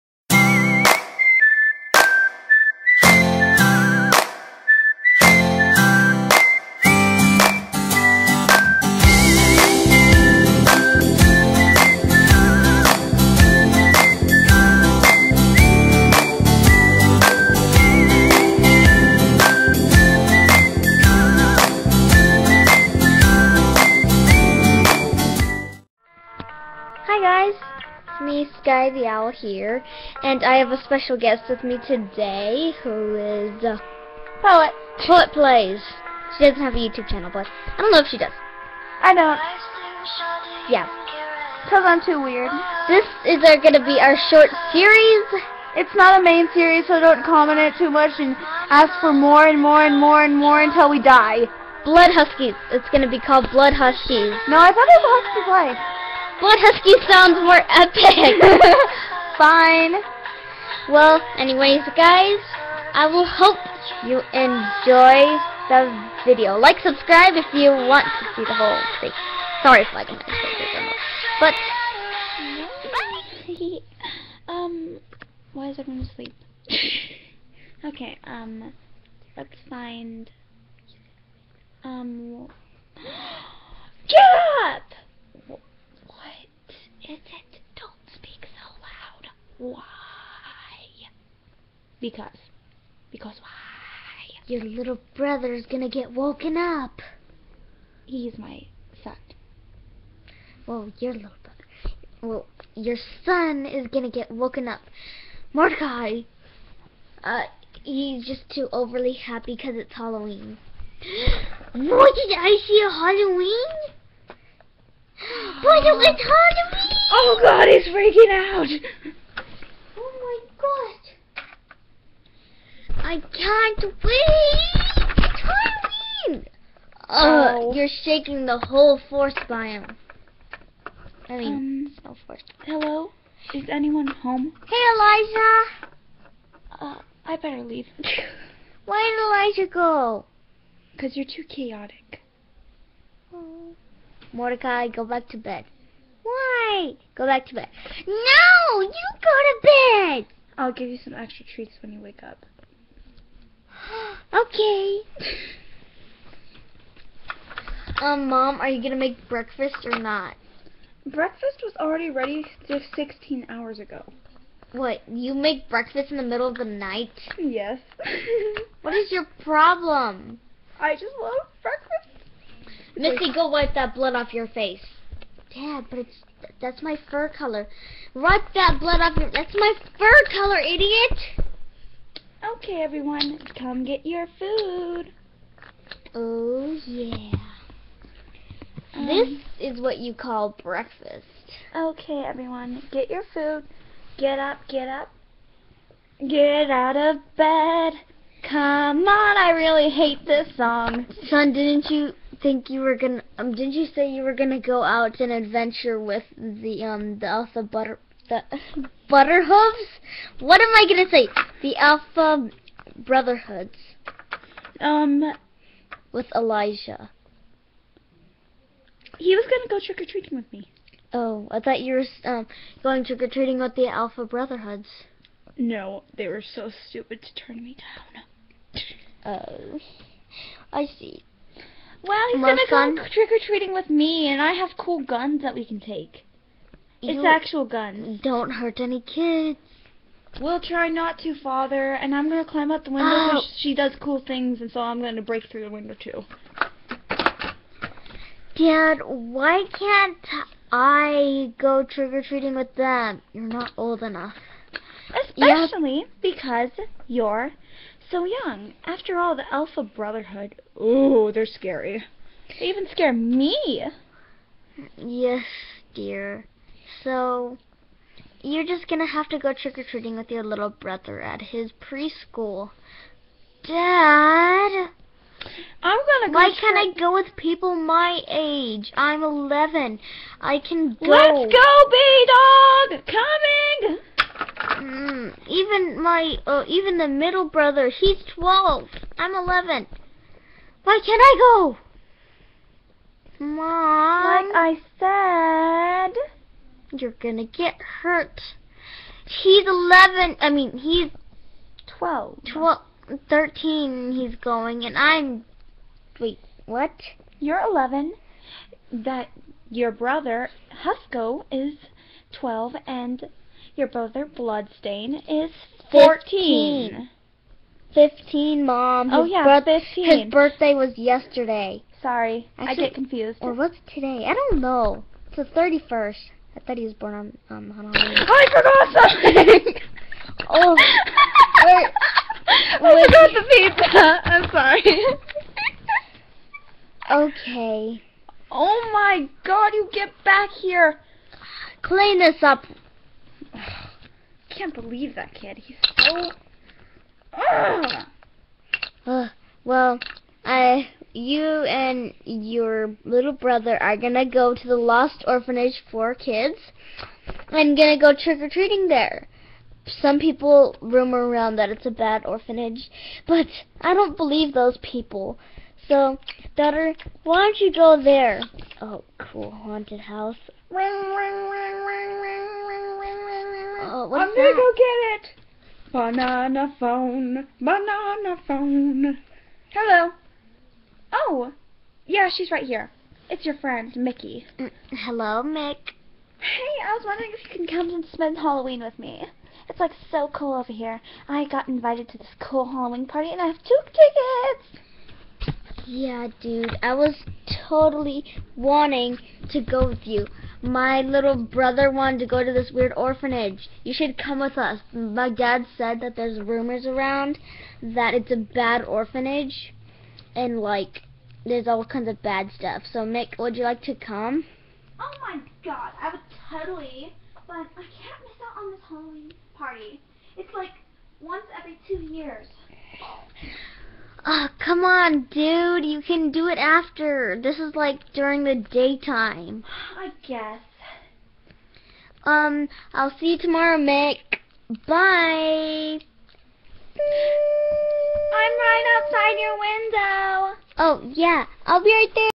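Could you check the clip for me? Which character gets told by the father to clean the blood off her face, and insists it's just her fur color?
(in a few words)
Missy.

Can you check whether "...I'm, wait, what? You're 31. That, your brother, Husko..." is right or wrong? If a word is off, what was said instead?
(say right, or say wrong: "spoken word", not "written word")
wrong: "11", not "31".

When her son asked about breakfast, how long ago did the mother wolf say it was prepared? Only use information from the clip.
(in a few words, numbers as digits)
16 hours ago.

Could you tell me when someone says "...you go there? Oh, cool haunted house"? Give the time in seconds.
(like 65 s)
367 s.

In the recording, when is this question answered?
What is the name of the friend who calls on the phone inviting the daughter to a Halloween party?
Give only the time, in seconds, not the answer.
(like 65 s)
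383 s.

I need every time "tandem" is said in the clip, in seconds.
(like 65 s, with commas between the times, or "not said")
not said.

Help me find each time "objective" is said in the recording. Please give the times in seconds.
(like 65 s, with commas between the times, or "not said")
not said.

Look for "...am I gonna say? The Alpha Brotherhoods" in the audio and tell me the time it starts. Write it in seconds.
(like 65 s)
210 s.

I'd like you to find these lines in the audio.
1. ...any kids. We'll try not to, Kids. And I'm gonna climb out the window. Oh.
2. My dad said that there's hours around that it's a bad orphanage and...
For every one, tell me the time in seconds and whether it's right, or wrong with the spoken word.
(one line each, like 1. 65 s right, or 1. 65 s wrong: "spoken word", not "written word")
1. 238 s wrong: "Father", not "Kids"
2. 404 s wrong: "rumors", not "hours".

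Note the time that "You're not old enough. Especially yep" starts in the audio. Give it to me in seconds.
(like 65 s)
253 s.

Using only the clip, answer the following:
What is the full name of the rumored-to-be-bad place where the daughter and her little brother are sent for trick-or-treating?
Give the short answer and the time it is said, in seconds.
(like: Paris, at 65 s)
Lost Orphanage for Kids, at 354 s.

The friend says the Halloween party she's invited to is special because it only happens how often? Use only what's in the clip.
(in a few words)
Once every two years.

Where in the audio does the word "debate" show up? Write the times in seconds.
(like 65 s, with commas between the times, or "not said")
not said.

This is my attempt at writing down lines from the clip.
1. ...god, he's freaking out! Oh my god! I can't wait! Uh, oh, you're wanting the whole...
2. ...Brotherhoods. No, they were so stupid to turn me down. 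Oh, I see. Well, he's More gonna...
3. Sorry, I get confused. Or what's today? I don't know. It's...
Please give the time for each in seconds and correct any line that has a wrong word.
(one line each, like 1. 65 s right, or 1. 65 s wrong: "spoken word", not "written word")
1. 117 s wrong: "shaking", not "wanting"
2. 224 s right
3. 322 s right.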